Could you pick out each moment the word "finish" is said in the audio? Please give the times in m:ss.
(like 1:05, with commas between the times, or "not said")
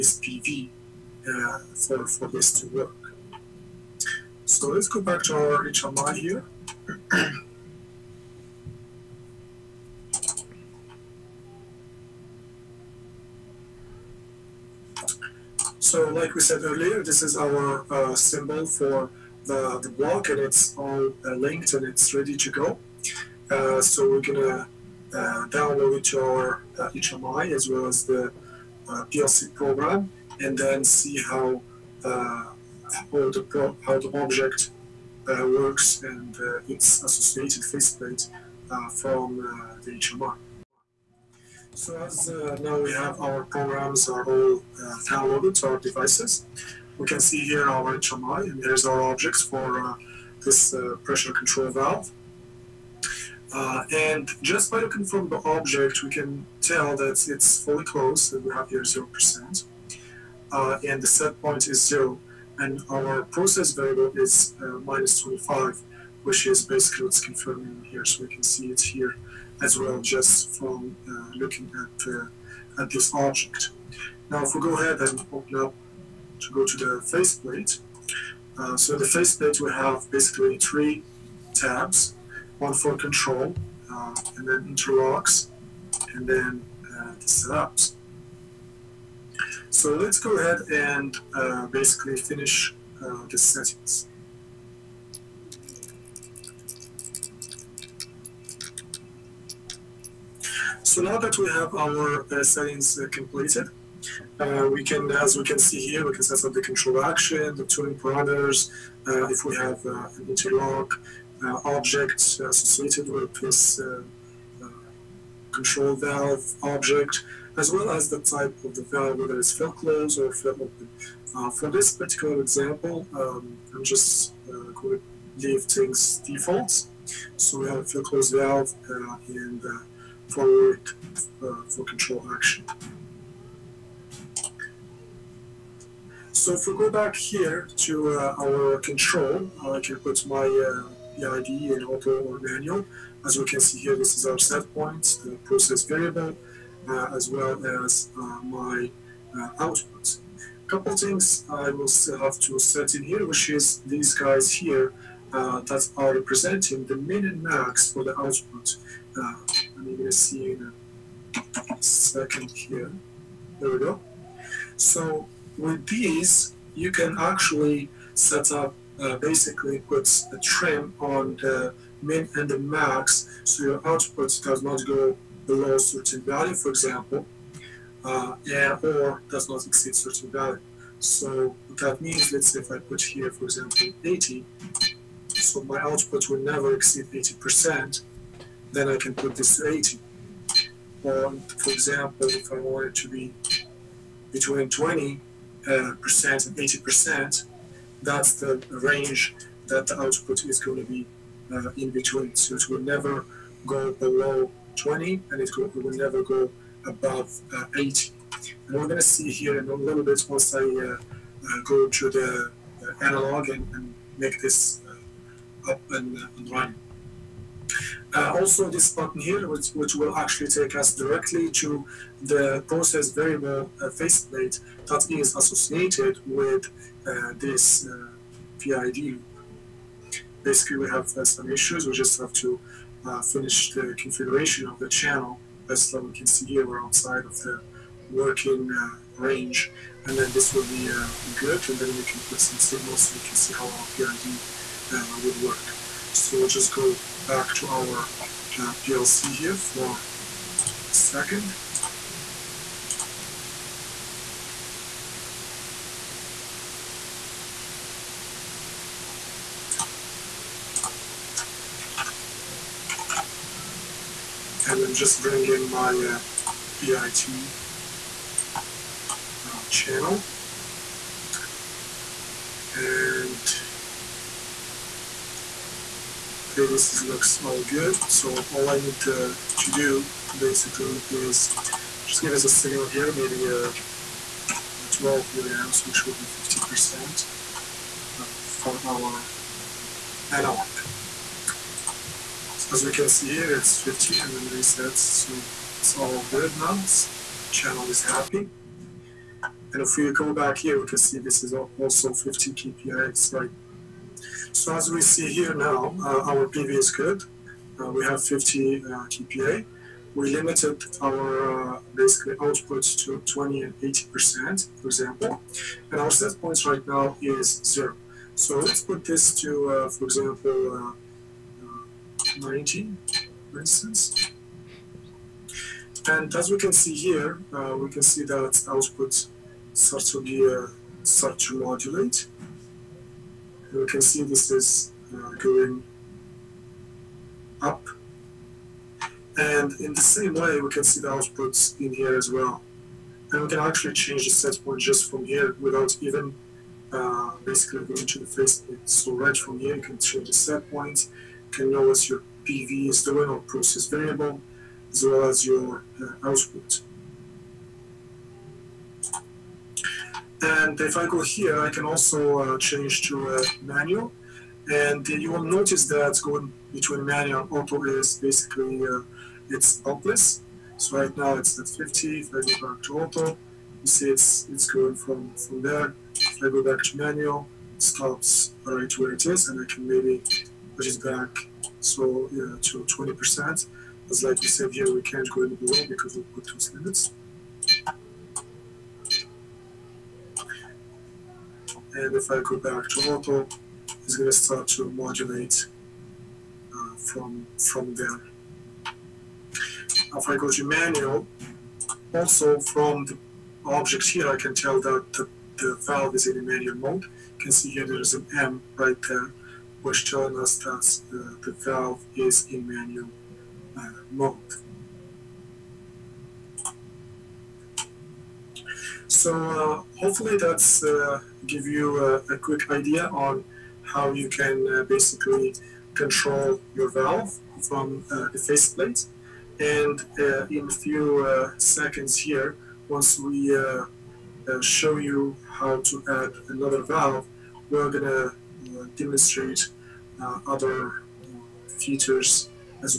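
1:32, 3:53.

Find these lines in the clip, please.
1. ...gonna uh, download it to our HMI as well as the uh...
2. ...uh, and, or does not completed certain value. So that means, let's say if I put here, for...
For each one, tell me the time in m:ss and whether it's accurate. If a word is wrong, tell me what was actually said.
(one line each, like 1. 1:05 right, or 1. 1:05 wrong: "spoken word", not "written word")
1. 0:24 right
2. 2:58 wrong: "exceed", not "completed".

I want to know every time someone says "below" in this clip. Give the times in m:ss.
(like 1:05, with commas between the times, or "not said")
2:55, 3:23, 6:25.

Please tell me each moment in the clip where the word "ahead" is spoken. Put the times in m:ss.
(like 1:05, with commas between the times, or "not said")
1:14, 1:30.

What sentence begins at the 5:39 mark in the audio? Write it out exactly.
And in the same way, we can see the outputs in here as well.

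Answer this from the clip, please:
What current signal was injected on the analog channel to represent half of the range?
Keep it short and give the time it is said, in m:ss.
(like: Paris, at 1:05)
12 milliamps, at 4:44.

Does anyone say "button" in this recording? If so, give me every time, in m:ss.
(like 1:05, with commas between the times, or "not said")
3:38.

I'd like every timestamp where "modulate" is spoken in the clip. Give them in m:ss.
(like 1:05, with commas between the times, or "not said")
5:31, 6:34.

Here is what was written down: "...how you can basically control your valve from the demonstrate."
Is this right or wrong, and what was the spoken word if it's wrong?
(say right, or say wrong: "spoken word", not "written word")
wrong: "faceplate", not "demonstrate".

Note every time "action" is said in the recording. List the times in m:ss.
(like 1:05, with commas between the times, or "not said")
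1:47, 2:12.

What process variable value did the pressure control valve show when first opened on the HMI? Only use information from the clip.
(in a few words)
-25.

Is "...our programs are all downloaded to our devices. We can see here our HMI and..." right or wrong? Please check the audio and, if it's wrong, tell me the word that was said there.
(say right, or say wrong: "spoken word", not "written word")
right.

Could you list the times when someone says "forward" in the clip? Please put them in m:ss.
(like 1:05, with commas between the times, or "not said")
2:10.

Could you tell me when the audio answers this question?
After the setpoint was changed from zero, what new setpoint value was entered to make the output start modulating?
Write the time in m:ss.
5:22.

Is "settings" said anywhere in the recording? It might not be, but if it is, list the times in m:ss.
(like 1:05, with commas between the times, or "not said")
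1:33, 1:42.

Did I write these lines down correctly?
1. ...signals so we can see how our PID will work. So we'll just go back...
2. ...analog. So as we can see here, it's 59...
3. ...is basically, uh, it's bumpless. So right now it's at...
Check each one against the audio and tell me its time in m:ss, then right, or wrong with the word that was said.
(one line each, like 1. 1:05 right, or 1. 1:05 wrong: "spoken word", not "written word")
1. 4:02 right
2. 4:50 wrong: "50", not "59"
3. 6:07 right.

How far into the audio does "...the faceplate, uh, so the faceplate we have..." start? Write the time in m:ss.
1:16.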